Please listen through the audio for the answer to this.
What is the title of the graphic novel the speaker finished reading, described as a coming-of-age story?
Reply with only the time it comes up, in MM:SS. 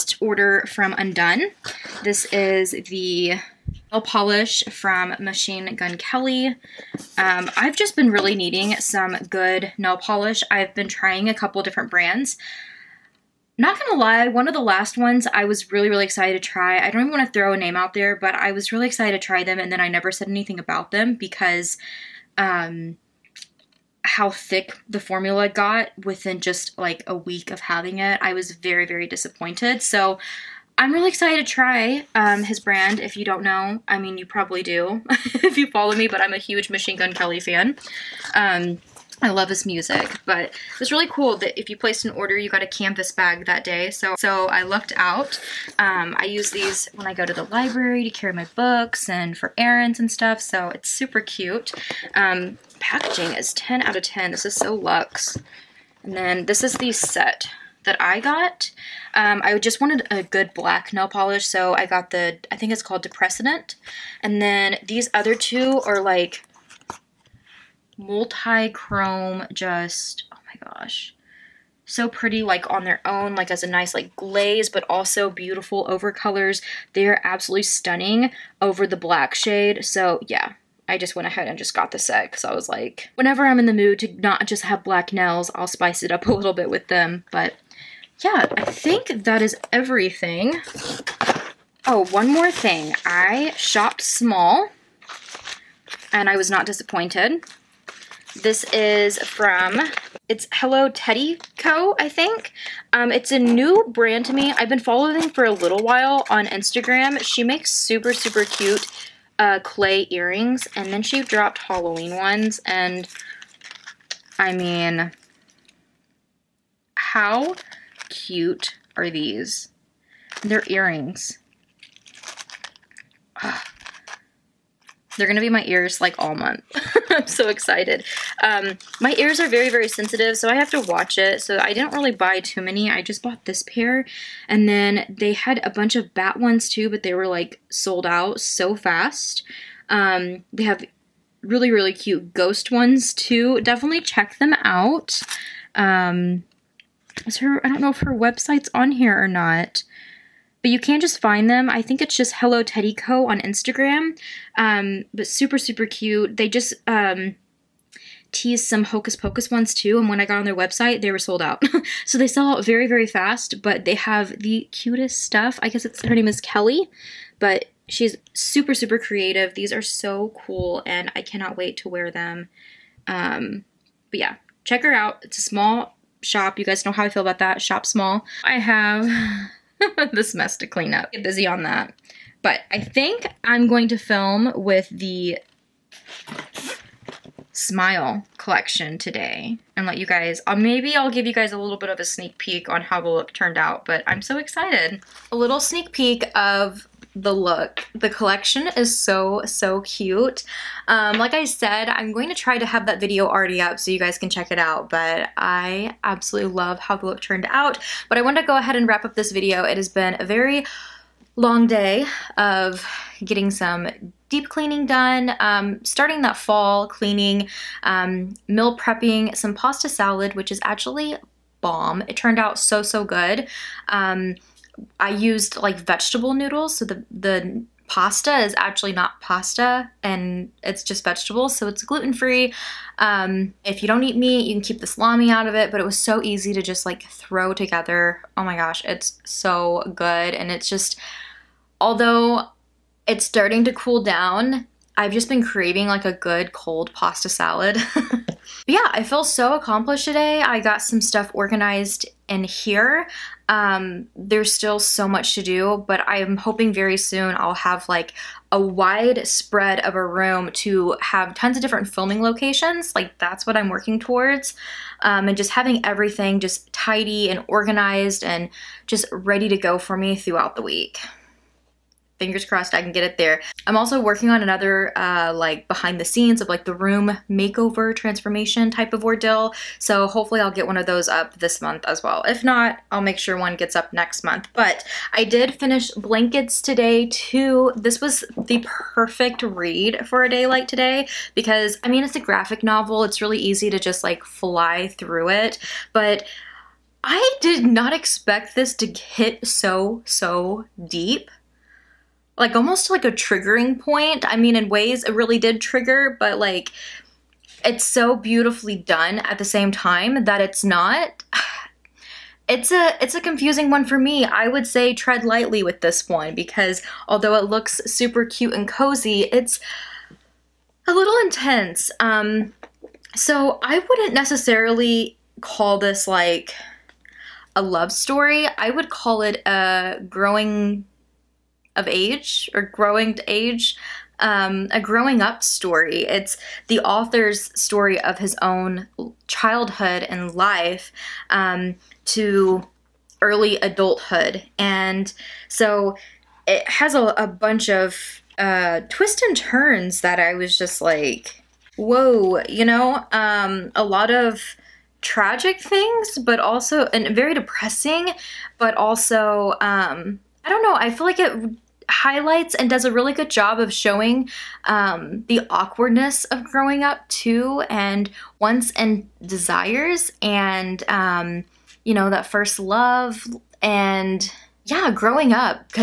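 04:45.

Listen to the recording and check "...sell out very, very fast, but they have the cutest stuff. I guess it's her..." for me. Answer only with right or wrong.
right.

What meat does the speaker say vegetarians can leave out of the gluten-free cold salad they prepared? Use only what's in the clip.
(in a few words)
salami.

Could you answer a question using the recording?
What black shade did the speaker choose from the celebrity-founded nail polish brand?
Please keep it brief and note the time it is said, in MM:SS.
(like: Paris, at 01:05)
Depressant, at 01:03.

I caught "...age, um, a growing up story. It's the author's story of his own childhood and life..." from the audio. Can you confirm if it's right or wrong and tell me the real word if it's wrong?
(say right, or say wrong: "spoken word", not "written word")
right.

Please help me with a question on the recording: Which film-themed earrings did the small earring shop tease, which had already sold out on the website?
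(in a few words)
Hocus Pocus.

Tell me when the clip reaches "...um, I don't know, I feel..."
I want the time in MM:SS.
05:59.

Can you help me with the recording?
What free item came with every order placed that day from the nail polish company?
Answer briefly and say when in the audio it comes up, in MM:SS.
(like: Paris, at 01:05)
canvas bag, at 00:42.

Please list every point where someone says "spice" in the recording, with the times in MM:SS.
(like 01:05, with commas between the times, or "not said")
01:25.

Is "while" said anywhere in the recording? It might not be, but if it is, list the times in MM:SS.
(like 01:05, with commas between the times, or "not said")
01:45.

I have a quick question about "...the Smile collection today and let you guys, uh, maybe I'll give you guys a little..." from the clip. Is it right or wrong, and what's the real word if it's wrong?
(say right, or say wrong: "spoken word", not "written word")
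right.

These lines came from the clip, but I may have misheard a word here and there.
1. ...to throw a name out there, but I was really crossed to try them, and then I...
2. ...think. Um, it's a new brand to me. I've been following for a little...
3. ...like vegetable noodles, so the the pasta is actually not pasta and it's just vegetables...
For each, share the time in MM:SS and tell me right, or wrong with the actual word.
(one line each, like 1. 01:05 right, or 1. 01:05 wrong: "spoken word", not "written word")
1. 00:17 wrong: "excited", not "crossed"
2. 01:42 right
3. 03:45 right.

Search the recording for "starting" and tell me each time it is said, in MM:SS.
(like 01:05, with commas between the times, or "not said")
03:35, 04:03.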